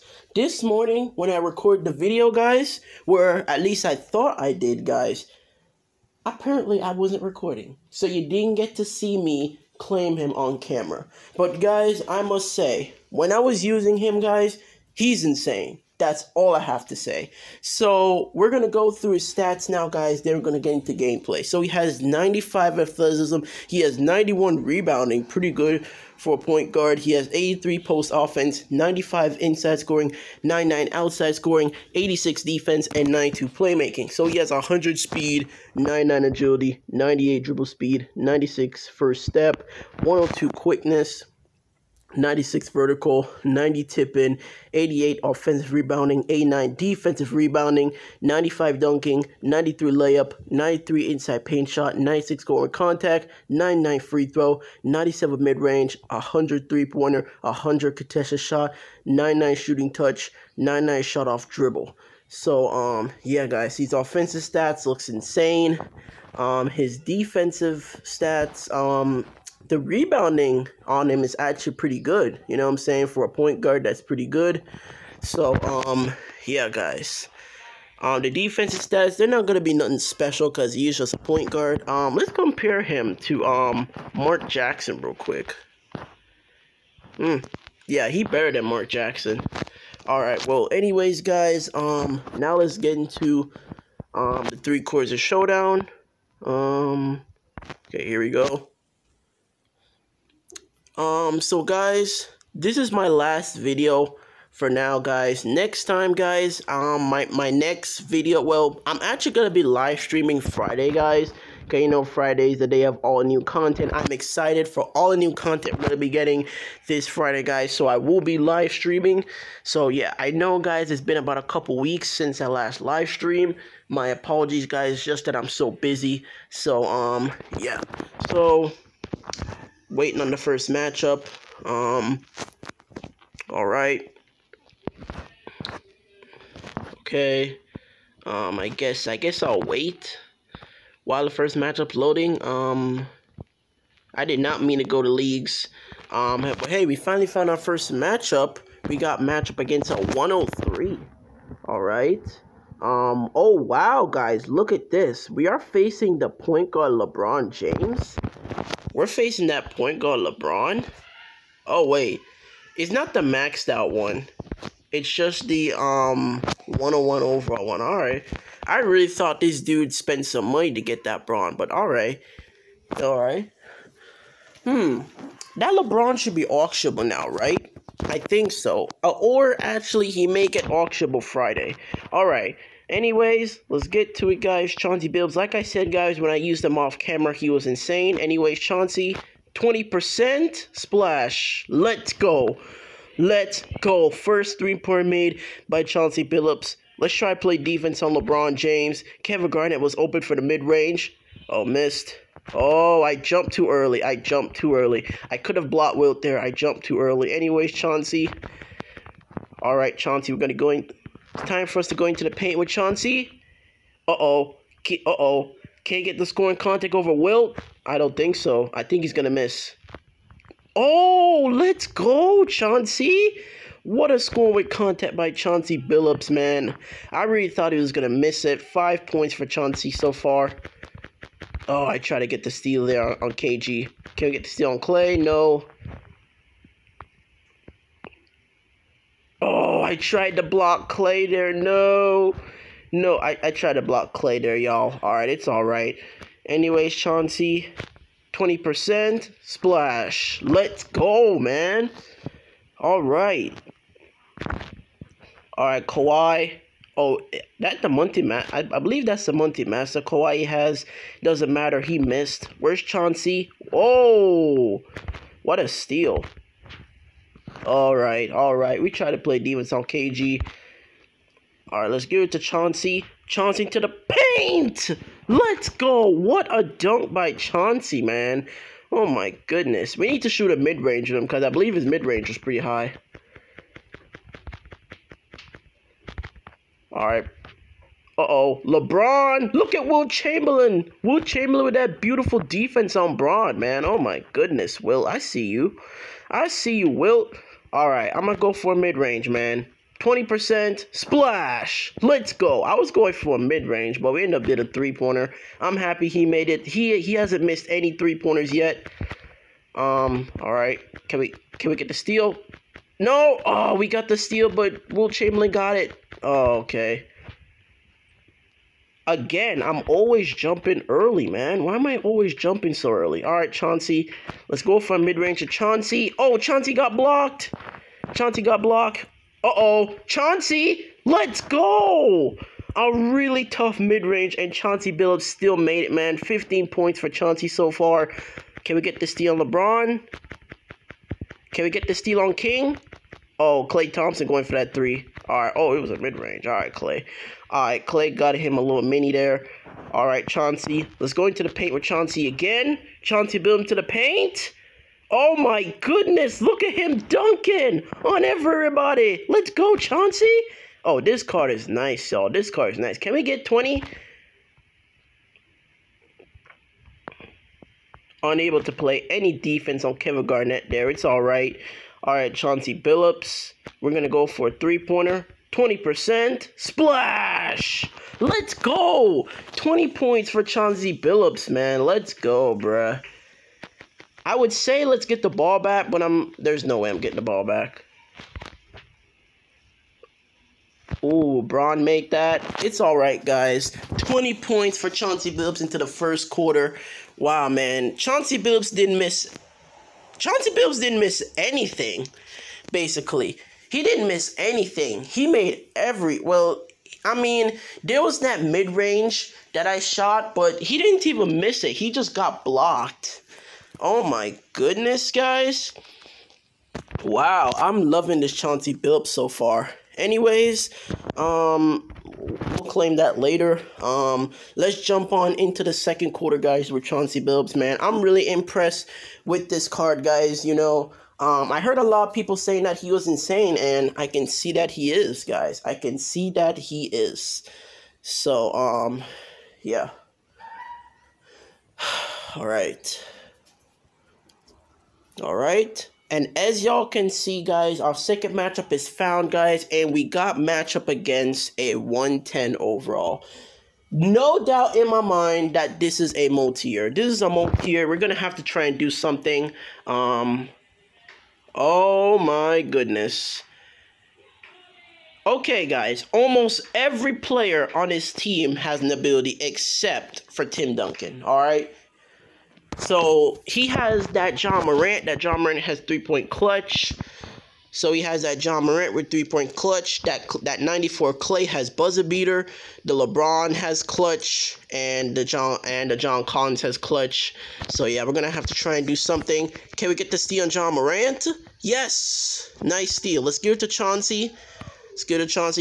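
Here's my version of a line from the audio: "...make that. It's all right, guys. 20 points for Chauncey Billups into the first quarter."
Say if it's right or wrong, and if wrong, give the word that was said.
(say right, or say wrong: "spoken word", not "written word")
right.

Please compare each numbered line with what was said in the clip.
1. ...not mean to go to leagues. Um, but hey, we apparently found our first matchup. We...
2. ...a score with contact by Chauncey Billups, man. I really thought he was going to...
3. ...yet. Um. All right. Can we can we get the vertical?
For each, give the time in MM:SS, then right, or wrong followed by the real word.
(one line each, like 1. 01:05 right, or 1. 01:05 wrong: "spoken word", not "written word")
1. 02:24 wrong: "finally", not "apparently"
2. 03:44 right
3. 05:08 wrong: "steal", not "vertical".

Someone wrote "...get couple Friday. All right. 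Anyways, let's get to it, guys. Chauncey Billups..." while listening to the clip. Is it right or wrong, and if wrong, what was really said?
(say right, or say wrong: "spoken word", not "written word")
wrong: "auctionable", not "couple".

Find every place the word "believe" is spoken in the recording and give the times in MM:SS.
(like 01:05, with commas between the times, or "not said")
04:18, 04:41.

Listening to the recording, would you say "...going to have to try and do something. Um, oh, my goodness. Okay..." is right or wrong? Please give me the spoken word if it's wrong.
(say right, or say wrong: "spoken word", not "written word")
right.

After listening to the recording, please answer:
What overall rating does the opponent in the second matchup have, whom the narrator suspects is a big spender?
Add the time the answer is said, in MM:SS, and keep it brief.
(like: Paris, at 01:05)
110, at 07:31.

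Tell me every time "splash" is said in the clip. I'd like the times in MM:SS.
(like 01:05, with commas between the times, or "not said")
03:10, 04:09, 05:00, 06:16.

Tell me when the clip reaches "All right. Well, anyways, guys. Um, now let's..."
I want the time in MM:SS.
01:30.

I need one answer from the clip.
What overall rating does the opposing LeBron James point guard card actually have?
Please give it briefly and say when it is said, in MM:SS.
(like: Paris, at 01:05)
101, at 02:46.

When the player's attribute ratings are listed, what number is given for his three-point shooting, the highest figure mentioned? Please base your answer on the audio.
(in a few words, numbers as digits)
103.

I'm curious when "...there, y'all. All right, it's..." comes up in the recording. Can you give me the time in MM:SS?
04:04.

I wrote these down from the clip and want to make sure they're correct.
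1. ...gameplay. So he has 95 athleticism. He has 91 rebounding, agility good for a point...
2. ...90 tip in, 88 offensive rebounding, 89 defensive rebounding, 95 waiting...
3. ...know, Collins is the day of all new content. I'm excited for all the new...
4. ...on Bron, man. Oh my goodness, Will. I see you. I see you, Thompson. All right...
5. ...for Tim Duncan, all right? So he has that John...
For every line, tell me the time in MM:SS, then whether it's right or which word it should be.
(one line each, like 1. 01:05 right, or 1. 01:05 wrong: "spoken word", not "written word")
1. 00:20 wrong: "pretty", not "agility"
2. 00:43 wrong: "dunking", not "waiting"
3. 01:51 wrong: "Friday", not "Collins"
4. 04:52 wrong: "Wilt", not "Thompson"
5. 07:50 right.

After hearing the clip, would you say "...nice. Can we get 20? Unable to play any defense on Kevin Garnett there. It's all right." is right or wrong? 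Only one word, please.
right.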